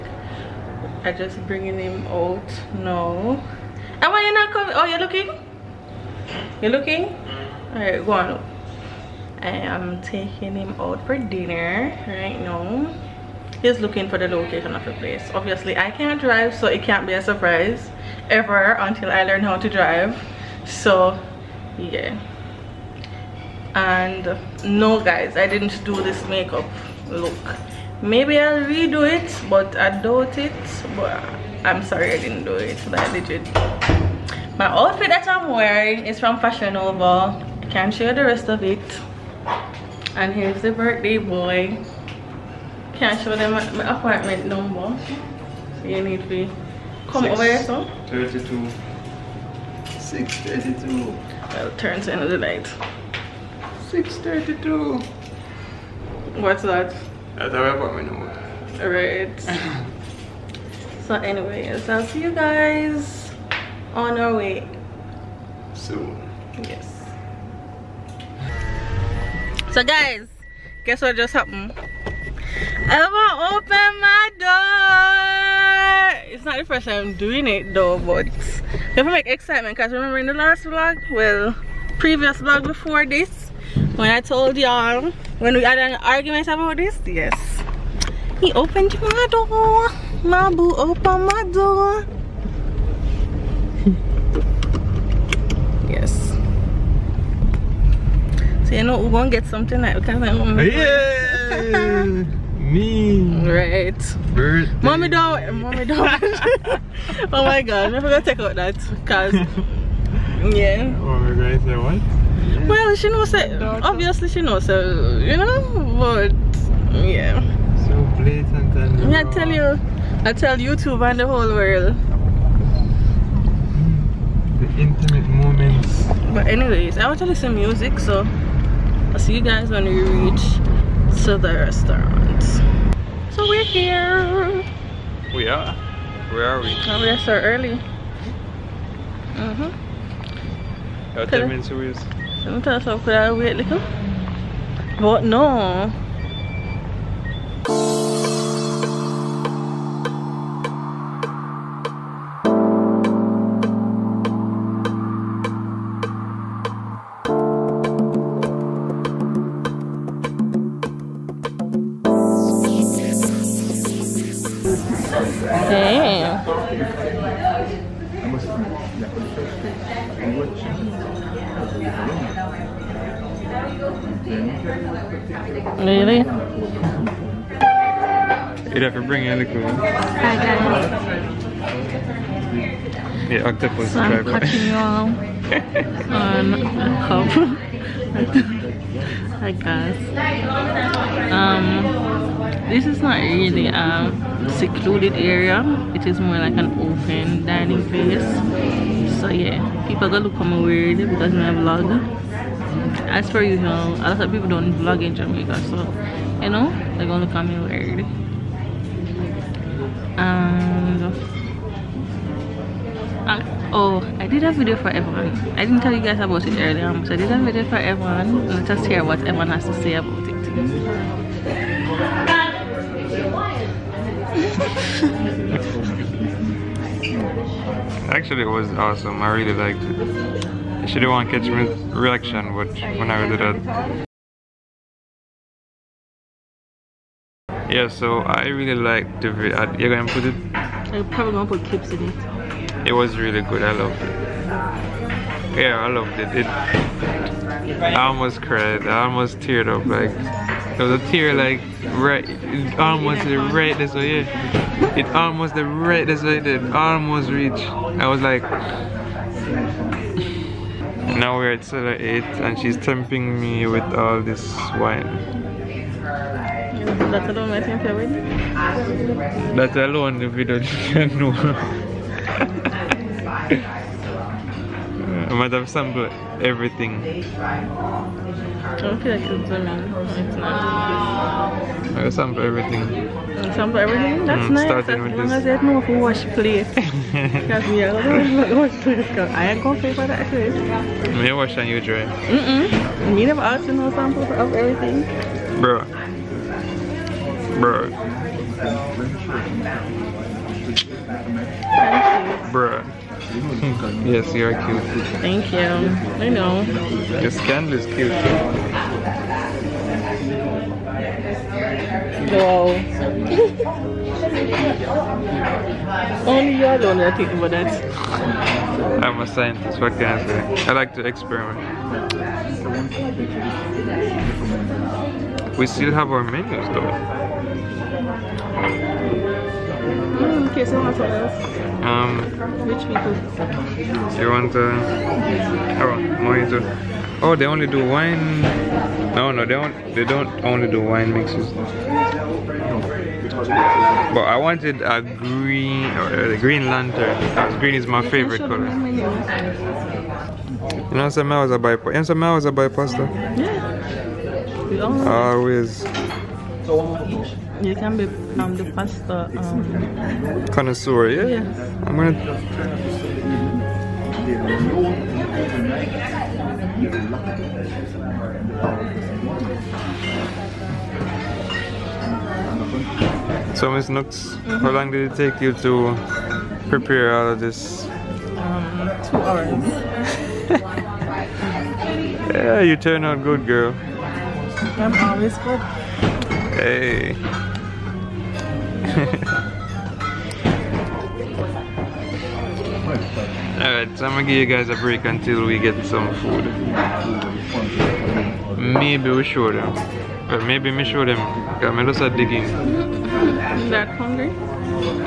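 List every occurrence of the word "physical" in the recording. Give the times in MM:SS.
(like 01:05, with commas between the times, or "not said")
not said.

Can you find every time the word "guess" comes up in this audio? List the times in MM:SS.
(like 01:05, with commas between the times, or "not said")
01:10, 03:09.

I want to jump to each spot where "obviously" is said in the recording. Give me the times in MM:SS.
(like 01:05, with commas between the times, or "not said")
00:15, 01:53.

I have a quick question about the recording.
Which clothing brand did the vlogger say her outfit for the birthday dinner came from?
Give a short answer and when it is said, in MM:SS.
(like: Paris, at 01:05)
Fashion Nova, at 00:36.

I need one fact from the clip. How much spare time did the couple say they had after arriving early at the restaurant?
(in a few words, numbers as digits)
10 minutes.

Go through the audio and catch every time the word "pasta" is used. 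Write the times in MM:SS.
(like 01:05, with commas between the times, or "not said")
05:52, 05:58.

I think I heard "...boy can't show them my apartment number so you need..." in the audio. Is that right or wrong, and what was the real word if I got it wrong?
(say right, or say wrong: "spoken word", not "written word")
right.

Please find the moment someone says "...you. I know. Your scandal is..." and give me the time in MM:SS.
05:05.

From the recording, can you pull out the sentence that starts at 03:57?
Yeah, so I really liked the video.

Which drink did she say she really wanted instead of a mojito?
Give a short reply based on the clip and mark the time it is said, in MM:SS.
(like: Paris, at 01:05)
Green lantern, at 05:46.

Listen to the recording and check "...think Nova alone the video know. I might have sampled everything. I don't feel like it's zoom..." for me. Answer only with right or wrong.
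wrong.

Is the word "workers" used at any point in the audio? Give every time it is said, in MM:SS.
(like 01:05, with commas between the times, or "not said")
not said.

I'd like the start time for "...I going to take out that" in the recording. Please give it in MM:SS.
01:47.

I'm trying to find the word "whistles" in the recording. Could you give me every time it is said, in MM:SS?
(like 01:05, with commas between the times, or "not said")
not said.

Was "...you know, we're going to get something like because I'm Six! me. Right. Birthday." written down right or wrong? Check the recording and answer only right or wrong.
wrong.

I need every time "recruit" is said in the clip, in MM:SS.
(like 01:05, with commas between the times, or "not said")
not said.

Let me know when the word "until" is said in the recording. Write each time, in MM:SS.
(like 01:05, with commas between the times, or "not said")
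00:18, 06:35.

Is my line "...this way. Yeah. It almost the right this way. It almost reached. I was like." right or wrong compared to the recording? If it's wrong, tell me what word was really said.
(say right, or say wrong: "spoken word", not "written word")
right.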